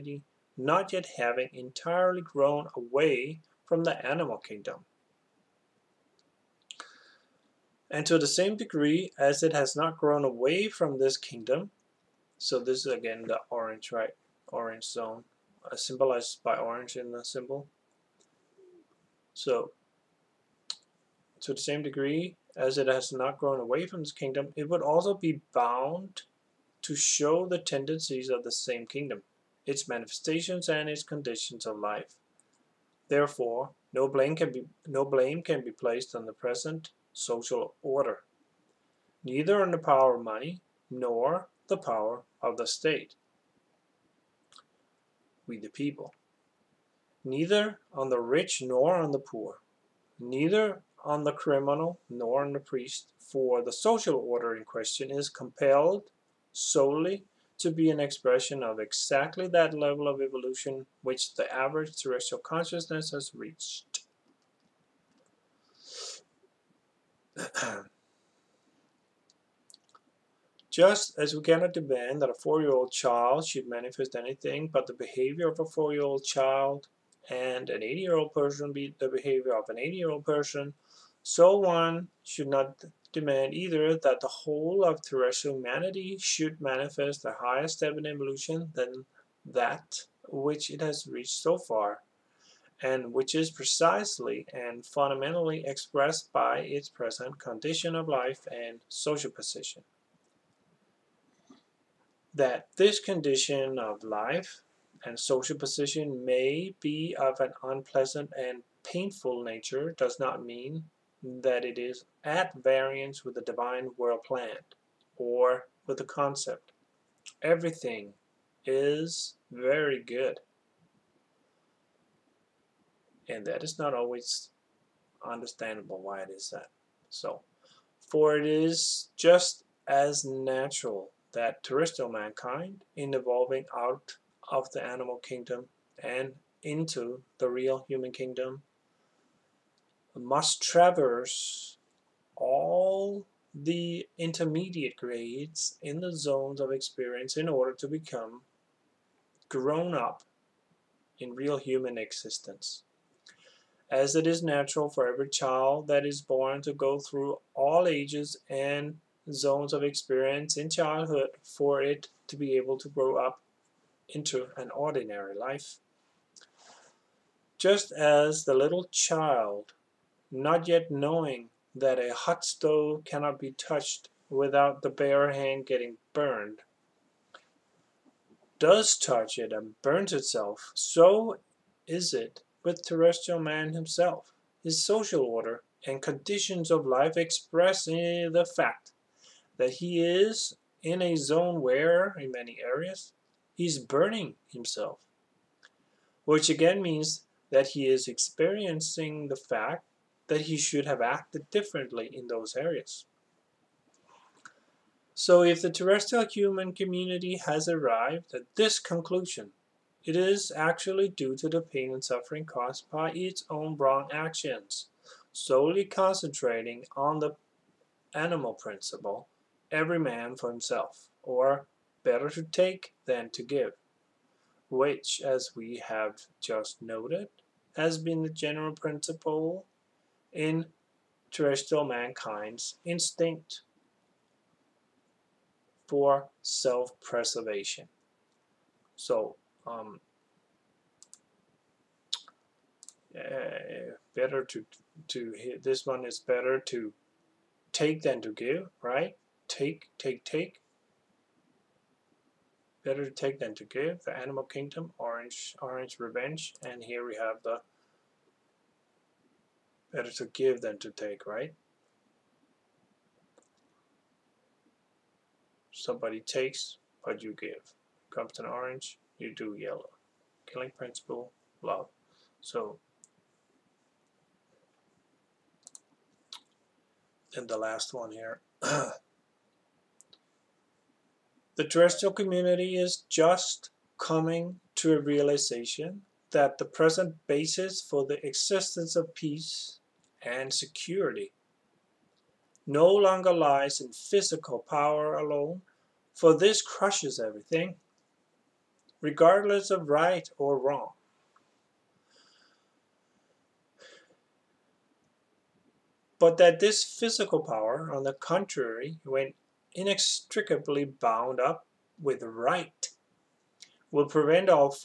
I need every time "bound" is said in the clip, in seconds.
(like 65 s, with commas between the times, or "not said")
25 s, 310 s.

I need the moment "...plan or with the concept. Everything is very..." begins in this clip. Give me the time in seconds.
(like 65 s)
114 s.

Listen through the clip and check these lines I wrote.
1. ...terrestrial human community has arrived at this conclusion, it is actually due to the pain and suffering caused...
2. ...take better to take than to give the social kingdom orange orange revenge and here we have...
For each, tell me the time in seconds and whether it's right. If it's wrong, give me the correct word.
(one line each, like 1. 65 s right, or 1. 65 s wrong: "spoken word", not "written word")
1. 205 s right
2. 250 s wrong: "animal", not "social".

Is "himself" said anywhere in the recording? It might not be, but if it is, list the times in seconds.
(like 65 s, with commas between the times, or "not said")
183 s, 194 s, 220 s.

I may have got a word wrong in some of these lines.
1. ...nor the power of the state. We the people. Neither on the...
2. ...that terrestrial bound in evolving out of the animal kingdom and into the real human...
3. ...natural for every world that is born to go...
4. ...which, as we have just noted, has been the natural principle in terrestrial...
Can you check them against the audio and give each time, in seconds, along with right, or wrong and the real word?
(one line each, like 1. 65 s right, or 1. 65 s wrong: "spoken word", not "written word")
1. 40 s right
2. 131 s wrong: "mankind", not "bound"
3. 154 s wrong: "child", not "world"
4. 224 s wrong: "general", not "natural".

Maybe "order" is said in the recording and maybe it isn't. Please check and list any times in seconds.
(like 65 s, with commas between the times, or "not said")
37 s, 54 s, 147 s, 185 s.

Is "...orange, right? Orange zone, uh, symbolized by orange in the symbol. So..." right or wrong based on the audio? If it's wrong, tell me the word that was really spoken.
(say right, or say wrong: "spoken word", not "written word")
right.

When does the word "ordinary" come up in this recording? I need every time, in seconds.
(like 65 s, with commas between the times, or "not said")
164 s.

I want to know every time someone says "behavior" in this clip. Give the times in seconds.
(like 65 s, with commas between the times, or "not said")
74 s, 79 s.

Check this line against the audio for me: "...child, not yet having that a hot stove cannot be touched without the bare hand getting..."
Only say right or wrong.
wrong.